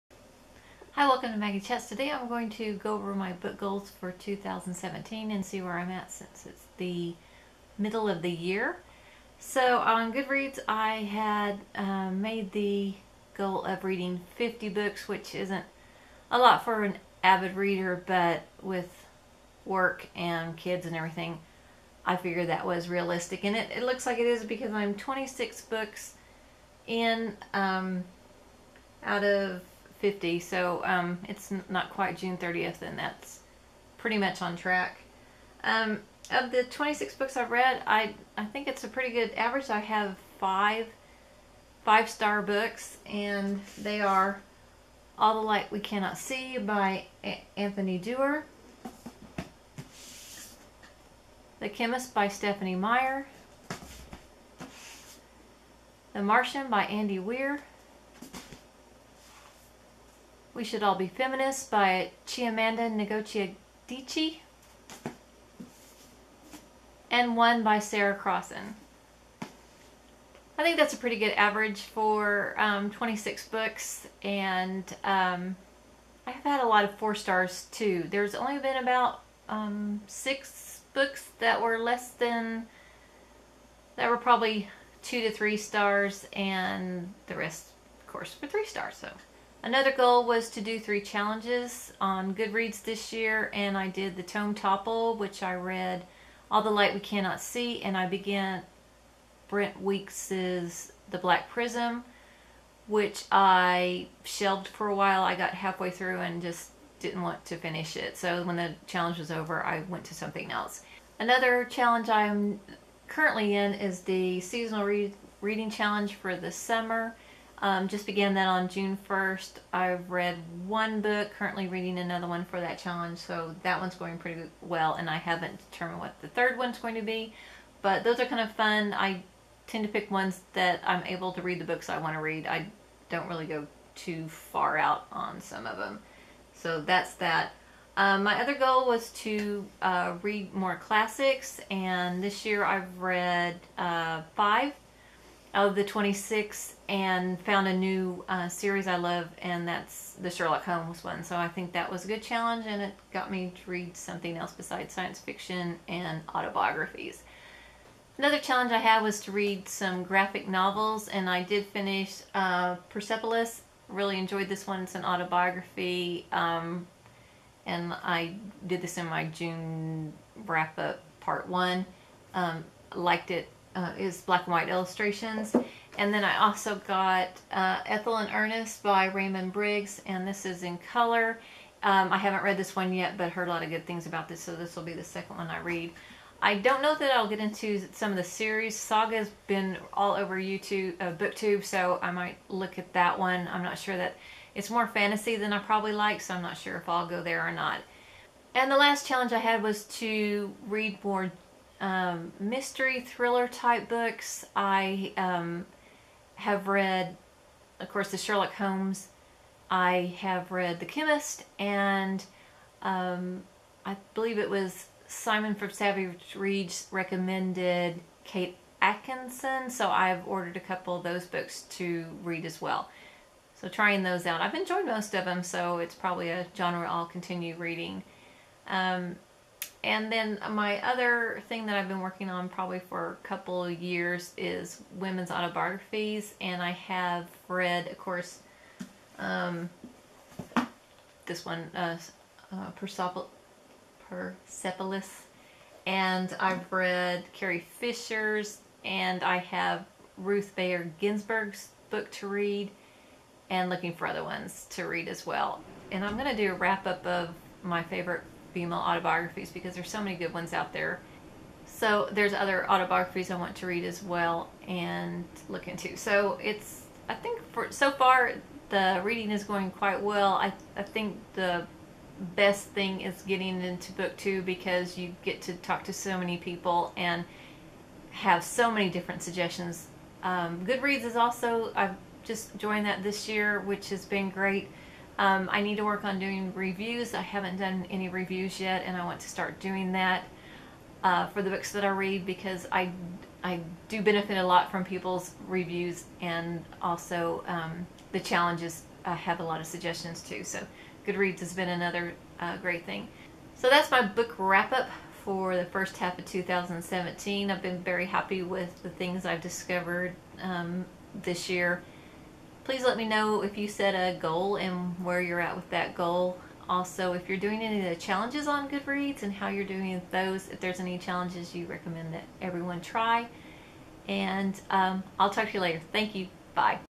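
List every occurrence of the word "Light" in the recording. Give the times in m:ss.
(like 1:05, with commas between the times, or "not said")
0:45, 1:36.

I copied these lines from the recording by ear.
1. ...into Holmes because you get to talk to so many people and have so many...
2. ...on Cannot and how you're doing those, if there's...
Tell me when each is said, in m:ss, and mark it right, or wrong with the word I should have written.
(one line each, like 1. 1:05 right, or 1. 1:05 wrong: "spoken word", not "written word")
1. 4:33 wrong: "BookTube", not "Holmes"
2. 5:18 wrong: "Goodreads", not "Cannot".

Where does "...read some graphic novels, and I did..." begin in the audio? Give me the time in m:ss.
2:39.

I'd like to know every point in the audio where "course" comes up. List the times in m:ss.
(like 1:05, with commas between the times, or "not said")
1:28, 3:27, 3:57.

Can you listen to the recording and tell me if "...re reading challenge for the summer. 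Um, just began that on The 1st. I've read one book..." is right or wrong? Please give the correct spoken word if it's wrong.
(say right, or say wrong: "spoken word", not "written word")
wrong: "June", not "The".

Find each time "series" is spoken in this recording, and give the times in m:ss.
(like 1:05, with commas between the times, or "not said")
2:28, 3:08.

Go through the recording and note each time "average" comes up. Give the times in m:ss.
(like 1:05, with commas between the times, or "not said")
0:39, 1:11.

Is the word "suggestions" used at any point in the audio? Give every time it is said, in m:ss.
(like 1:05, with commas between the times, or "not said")
4:39, 4:59.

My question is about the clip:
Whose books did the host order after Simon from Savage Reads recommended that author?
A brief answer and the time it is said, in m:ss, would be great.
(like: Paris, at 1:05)
Kate Atkinson, at 3:38.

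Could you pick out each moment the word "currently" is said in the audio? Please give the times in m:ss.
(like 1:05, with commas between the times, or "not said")
1:53, 2:01.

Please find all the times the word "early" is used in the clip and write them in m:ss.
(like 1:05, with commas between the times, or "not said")
not said.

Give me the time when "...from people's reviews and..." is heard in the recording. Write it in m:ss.
4:54.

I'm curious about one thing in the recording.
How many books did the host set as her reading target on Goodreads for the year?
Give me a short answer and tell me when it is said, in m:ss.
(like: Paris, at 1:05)
50, at 0:14.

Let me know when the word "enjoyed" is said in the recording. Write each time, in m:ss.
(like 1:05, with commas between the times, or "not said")
2:44, 3:44.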